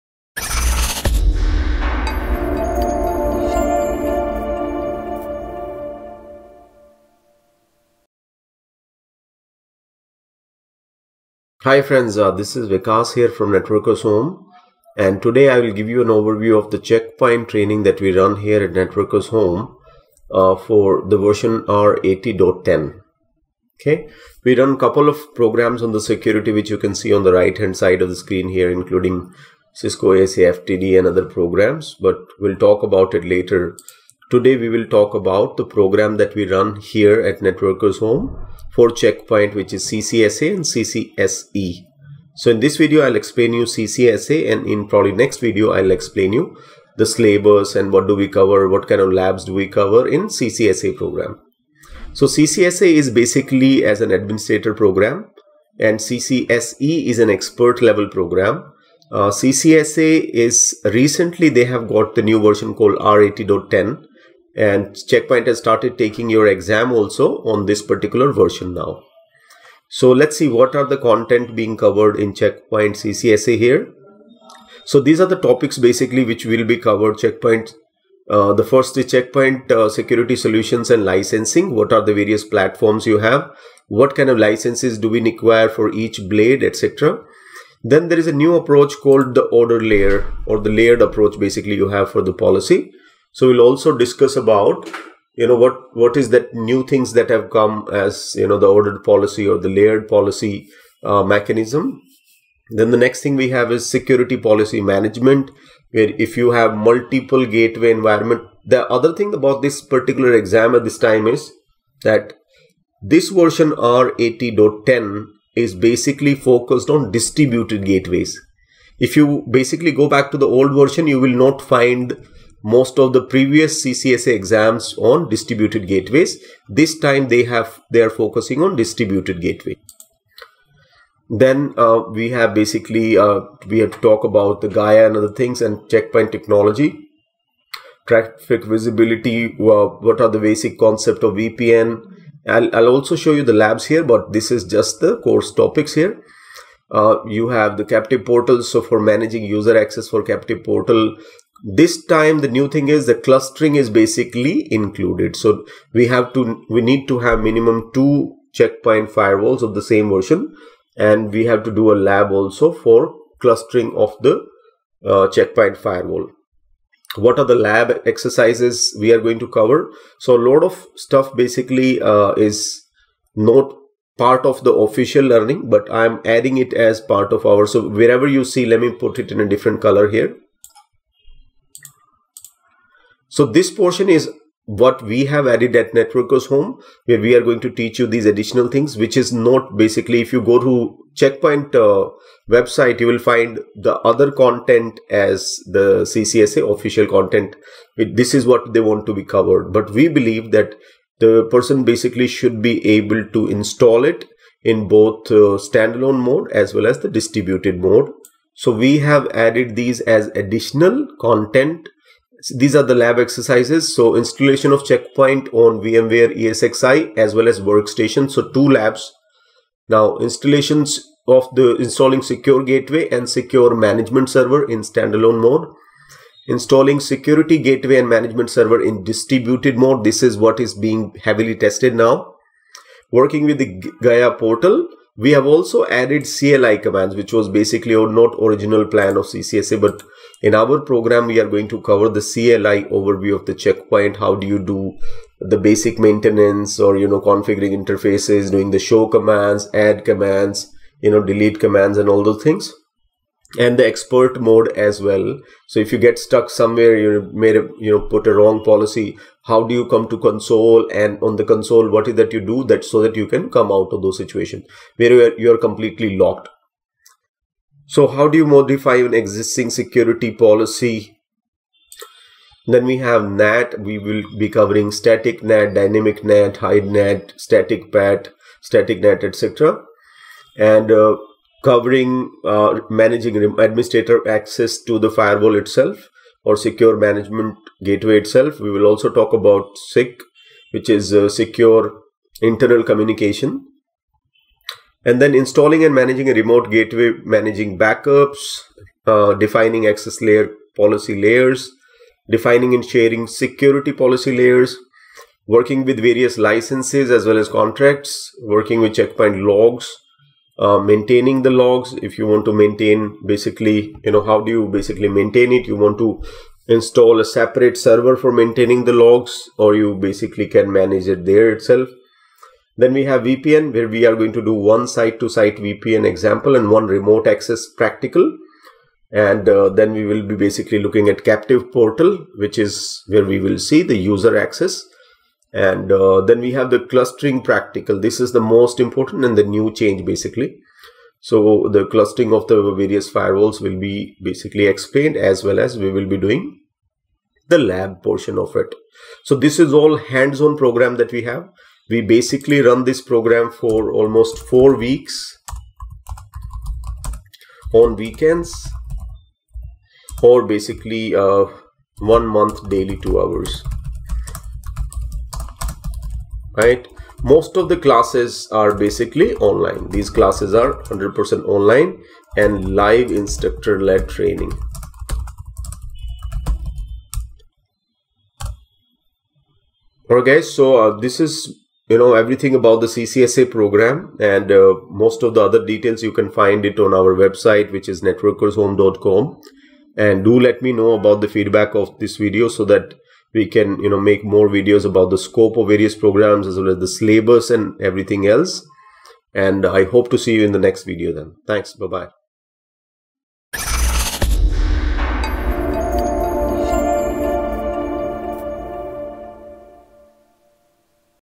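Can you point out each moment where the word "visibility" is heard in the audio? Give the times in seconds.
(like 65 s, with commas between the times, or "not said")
138 s.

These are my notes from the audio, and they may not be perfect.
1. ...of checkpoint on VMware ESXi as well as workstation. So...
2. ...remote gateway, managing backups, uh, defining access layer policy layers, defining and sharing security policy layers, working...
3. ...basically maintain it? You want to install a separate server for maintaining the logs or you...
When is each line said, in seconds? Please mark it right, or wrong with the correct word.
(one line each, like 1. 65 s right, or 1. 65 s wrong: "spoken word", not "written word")
1. 214 s right
2. 296 s right
3. 314 s right.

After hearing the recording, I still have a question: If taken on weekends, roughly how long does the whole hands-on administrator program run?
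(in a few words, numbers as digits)
4 weeks.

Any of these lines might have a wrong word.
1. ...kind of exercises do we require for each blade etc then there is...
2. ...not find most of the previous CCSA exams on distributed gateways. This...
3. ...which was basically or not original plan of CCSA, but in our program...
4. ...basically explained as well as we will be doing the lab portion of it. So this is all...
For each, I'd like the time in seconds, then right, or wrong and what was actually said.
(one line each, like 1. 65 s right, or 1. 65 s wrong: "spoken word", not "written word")
1. 84 s wrong: "licenses", not "exercises"
2. 121 s right
3. 237 s right
4. 344 s right.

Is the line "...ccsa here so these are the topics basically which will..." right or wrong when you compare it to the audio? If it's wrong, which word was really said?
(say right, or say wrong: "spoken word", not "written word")
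right.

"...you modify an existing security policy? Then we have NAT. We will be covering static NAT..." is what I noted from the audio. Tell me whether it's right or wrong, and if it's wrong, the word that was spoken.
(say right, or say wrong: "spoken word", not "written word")
right.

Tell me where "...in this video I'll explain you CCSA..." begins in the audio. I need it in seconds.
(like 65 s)
42 s.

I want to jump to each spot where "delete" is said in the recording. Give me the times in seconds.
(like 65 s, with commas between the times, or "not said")
251 s.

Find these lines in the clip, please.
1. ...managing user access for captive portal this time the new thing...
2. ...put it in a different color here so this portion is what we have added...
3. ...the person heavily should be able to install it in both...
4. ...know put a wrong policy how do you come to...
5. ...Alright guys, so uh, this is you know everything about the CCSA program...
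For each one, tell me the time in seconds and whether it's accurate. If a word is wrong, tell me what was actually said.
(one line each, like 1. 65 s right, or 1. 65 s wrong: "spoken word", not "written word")
1. 148 s right
2. 178 s right
3. 201 s wrong: "basically", not "heavily"
4. 257 s right
5. 380 s right.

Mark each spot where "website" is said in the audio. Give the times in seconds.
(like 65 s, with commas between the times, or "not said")
192 s, 387 s.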